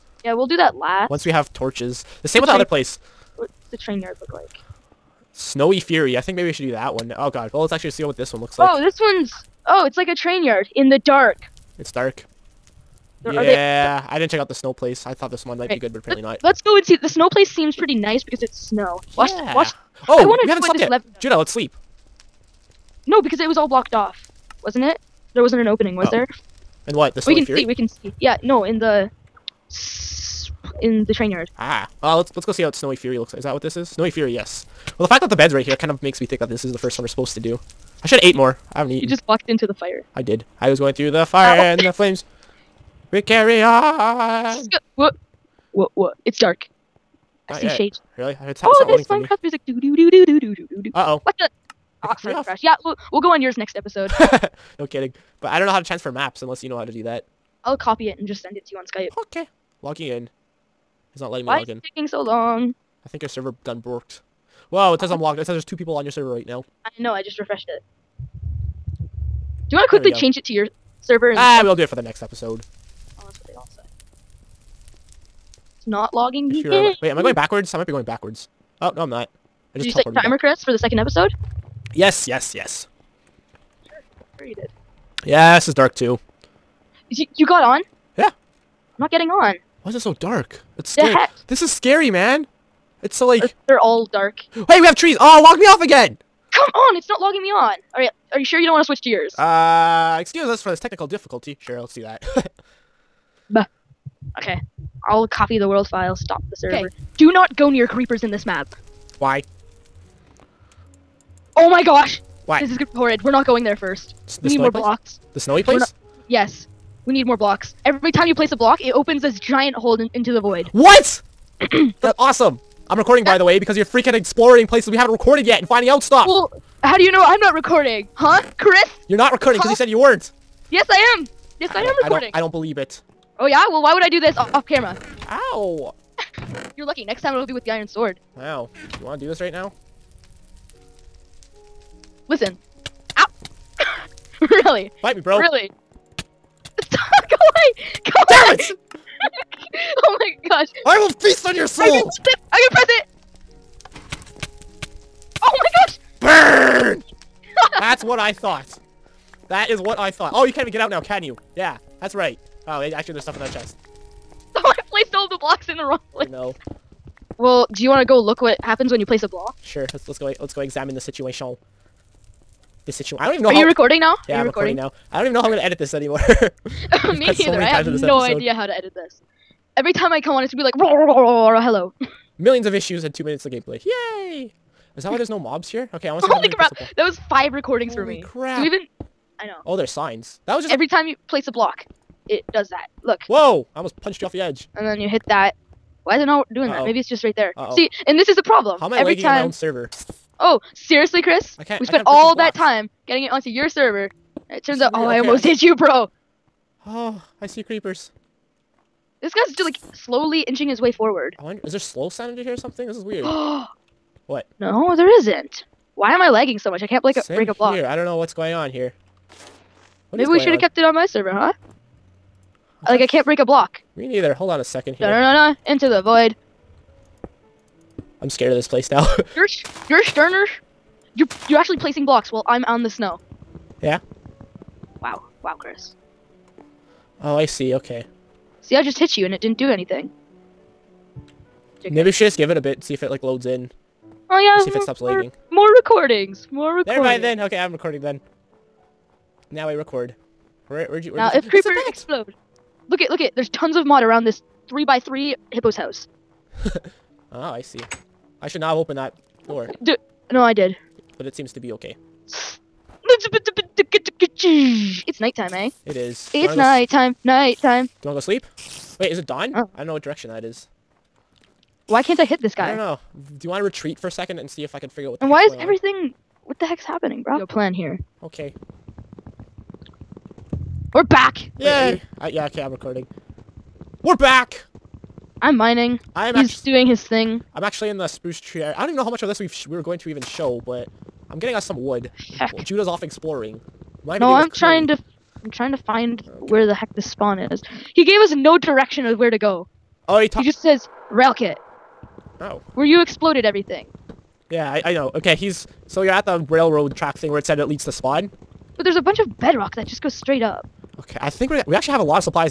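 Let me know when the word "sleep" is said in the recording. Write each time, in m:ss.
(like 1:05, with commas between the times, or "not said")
0:21, 4:28.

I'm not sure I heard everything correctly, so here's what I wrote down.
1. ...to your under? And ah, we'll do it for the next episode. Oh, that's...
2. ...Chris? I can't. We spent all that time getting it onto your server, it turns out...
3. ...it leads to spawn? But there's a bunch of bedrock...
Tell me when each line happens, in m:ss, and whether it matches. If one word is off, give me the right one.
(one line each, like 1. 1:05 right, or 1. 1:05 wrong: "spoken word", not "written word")
1. 1:10 wrong: "server", not "under"
2. 3:21 right
3. 5:07 right.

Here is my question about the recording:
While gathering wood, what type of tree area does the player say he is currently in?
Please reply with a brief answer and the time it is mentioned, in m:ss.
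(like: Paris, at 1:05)
spruce, at 4:48.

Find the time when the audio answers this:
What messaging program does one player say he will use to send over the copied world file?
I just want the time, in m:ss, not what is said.
0:58.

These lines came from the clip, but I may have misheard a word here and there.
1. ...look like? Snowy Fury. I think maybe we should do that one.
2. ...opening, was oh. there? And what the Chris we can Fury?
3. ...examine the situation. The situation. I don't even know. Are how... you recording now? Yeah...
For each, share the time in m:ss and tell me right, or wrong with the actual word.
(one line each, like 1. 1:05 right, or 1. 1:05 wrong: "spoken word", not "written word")
1. 0:04 right
2. 0:25 wrong: "Story", not "Chris"
3. 2:50 right.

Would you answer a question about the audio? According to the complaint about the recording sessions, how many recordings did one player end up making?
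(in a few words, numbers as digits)
5.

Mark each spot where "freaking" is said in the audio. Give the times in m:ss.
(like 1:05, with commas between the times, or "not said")
2:03.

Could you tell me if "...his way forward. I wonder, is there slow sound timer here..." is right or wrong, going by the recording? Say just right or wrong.
wrong.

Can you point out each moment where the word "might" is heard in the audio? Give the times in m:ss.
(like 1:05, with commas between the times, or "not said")
0:15, 1:17.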